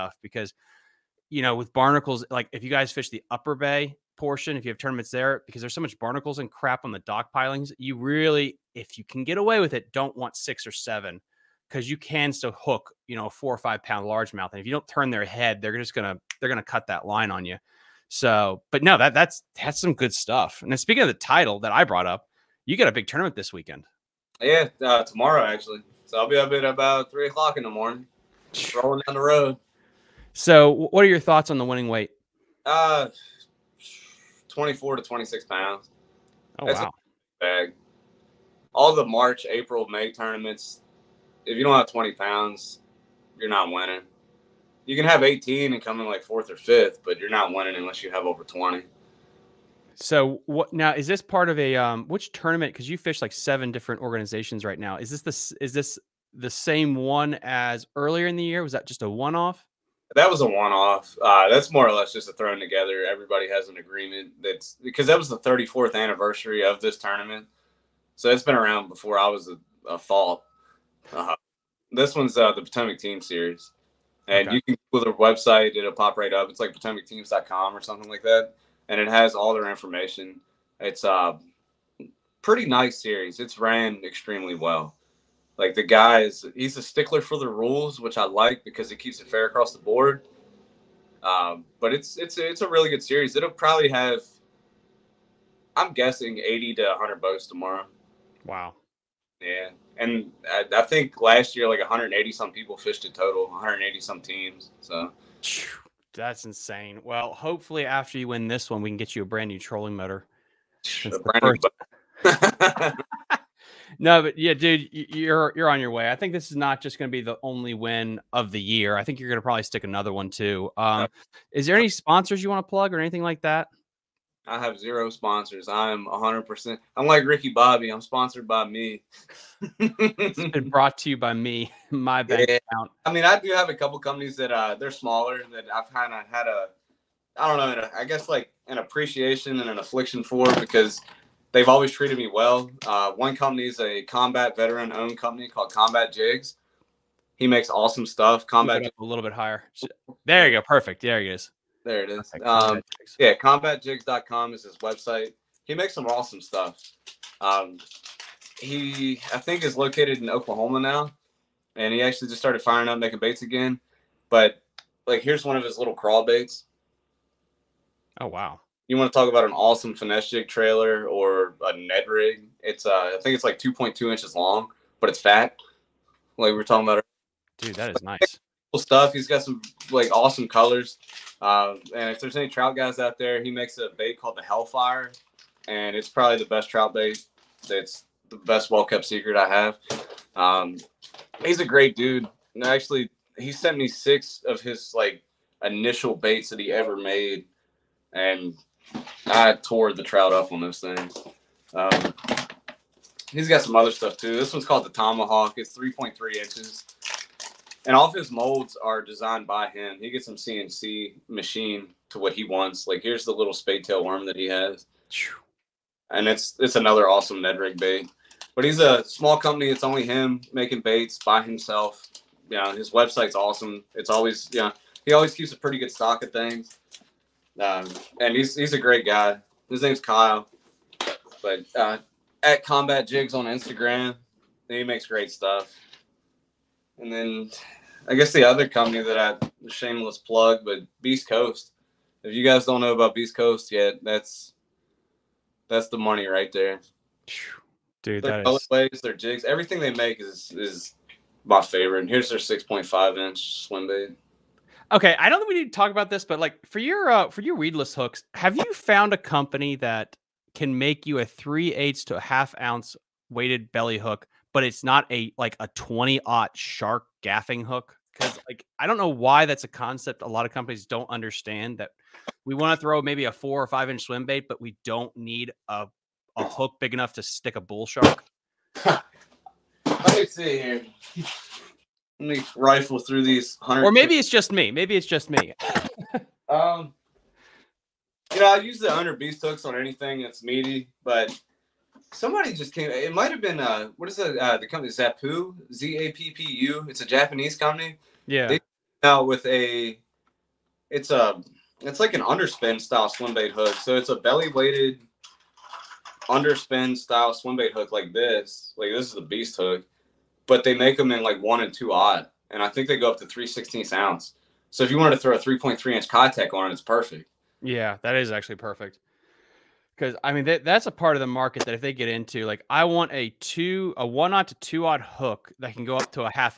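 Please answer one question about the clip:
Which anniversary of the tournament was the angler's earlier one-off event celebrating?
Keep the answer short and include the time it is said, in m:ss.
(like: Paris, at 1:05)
34th, at 1:05.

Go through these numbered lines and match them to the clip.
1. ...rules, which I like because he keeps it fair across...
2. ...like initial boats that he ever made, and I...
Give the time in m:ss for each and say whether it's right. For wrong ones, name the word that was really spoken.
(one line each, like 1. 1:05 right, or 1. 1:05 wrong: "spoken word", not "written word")
1. 1:27 right
2. 3:14 wrong: "baits", not "boats".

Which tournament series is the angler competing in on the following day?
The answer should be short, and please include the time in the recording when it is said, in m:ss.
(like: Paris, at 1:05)
Potomac Team Series, at 1:12.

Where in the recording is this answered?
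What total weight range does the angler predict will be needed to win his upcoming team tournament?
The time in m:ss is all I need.
0:34.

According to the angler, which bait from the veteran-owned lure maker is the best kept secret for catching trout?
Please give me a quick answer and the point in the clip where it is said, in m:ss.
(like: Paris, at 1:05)
Hellfire, at 3:04.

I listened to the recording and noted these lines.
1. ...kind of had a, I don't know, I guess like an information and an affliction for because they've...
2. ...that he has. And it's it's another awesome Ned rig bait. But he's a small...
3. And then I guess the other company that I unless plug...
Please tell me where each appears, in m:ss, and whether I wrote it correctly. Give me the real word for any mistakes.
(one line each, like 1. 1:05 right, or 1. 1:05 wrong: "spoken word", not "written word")
1. 2:15 wrong: "appreciation", not "information"
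2. 3:34 right
3. 3:56 wrong: "shameless", not "unless".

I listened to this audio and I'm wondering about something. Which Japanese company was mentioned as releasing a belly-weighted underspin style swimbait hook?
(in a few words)
Zappu.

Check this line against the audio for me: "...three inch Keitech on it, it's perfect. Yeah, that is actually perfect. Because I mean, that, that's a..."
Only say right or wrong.
right.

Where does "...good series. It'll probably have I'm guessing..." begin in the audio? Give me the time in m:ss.
1:32.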